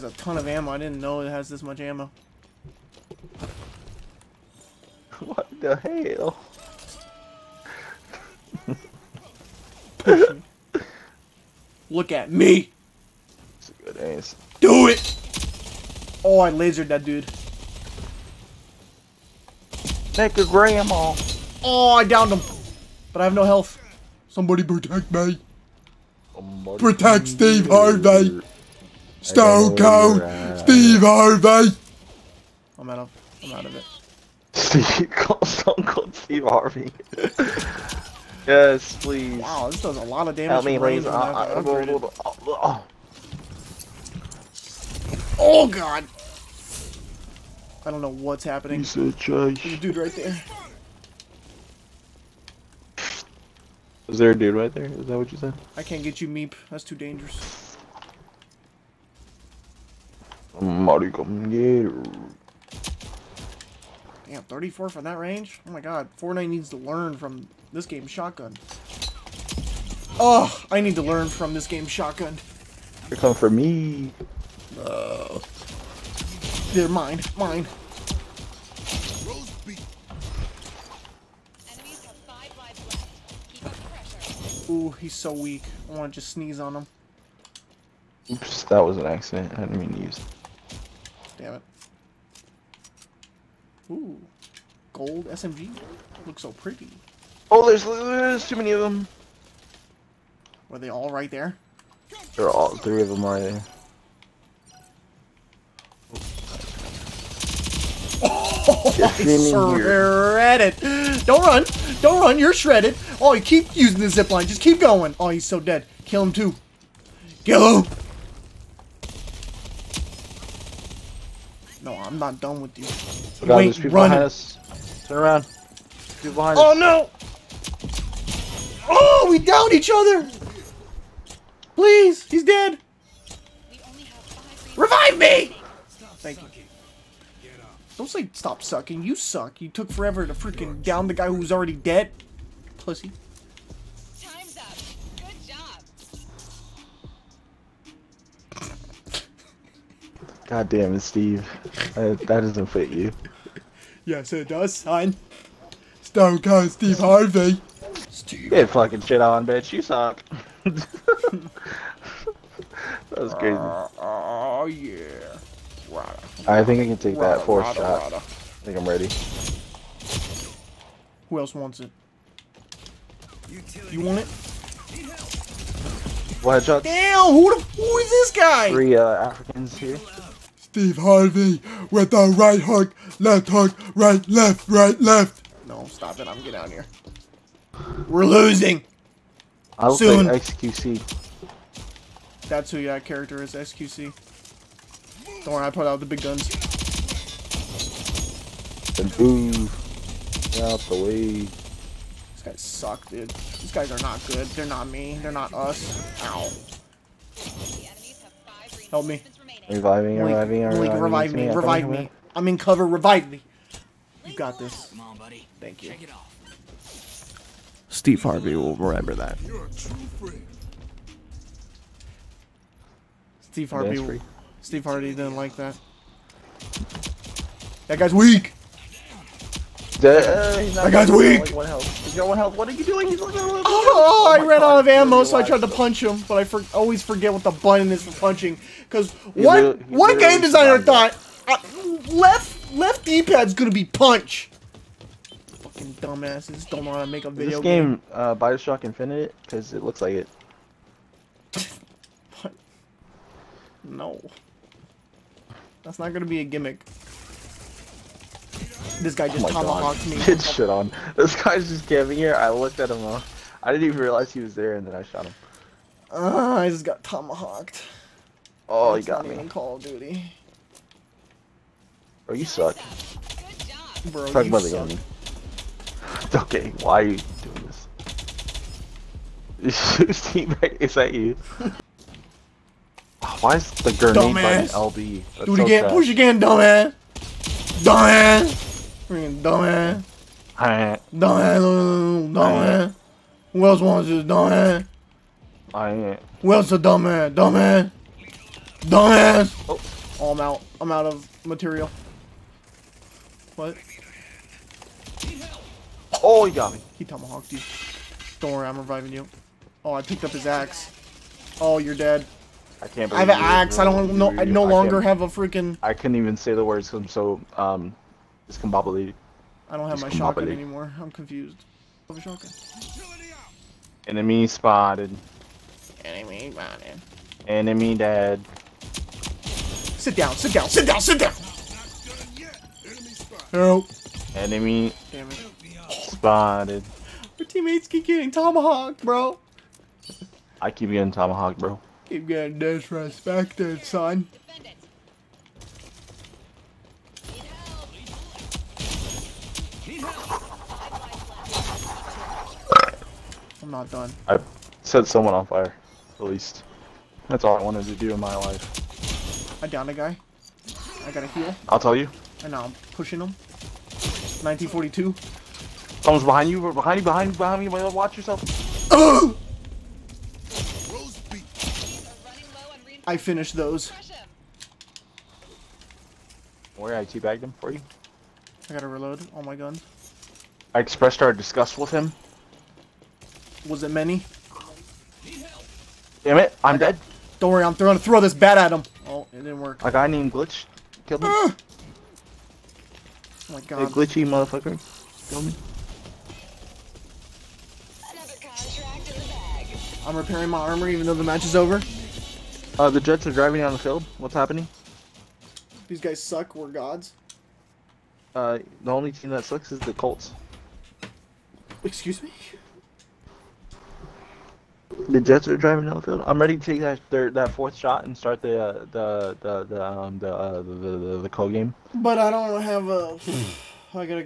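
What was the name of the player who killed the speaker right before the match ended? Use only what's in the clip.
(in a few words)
Glitch.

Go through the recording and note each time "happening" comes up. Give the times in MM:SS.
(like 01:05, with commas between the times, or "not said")
00:48, 06:44.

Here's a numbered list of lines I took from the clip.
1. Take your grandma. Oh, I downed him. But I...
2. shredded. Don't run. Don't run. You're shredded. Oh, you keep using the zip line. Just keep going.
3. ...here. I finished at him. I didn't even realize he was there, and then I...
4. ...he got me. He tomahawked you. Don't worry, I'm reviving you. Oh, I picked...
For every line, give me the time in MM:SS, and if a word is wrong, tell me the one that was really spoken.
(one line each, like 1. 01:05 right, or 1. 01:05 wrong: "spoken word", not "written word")
1. 00:20 right
2. 01:49 right
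3. 04:22 wrong: "looked", not "finished"
4. 05:06 right.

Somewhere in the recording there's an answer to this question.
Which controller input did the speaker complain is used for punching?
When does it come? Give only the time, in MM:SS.
04:02.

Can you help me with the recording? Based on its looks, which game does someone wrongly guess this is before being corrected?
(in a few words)
Bioshock Infinite.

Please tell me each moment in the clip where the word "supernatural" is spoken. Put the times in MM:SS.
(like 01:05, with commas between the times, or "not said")
not said.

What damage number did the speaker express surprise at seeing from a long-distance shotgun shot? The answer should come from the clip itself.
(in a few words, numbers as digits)
34.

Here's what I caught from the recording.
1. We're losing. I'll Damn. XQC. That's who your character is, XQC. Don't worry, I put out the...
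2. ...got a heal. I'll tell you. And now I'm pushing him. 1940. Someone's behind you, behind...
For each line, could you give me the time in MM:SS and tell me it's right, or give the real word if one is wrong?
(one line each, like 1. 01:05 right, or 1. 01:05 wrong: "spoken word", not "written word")
1. 03:08 wrong: "Soon", not "Damn"
2. 06:01 wrong: "1942", not "1940".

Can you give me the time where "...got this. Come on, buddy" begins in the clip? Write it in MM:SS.
03:34.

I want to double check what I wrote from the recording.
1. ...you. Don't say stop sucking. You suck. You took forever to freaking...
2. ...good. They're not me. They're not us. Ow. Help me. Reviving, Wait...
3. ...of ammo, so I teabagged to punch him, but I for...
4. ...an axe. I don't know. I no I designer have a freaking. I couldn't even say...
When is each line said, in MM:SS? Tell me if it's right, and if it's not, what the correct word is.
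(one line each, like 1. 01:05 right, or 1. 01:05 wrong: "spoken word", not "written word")
1. 02:16 right
2. 03:24 wrong: "Link", not "Wait"
3. 03:54 wrong: "tried", not "teabagged"
4. 05:13 wrong: "longer", not "designer".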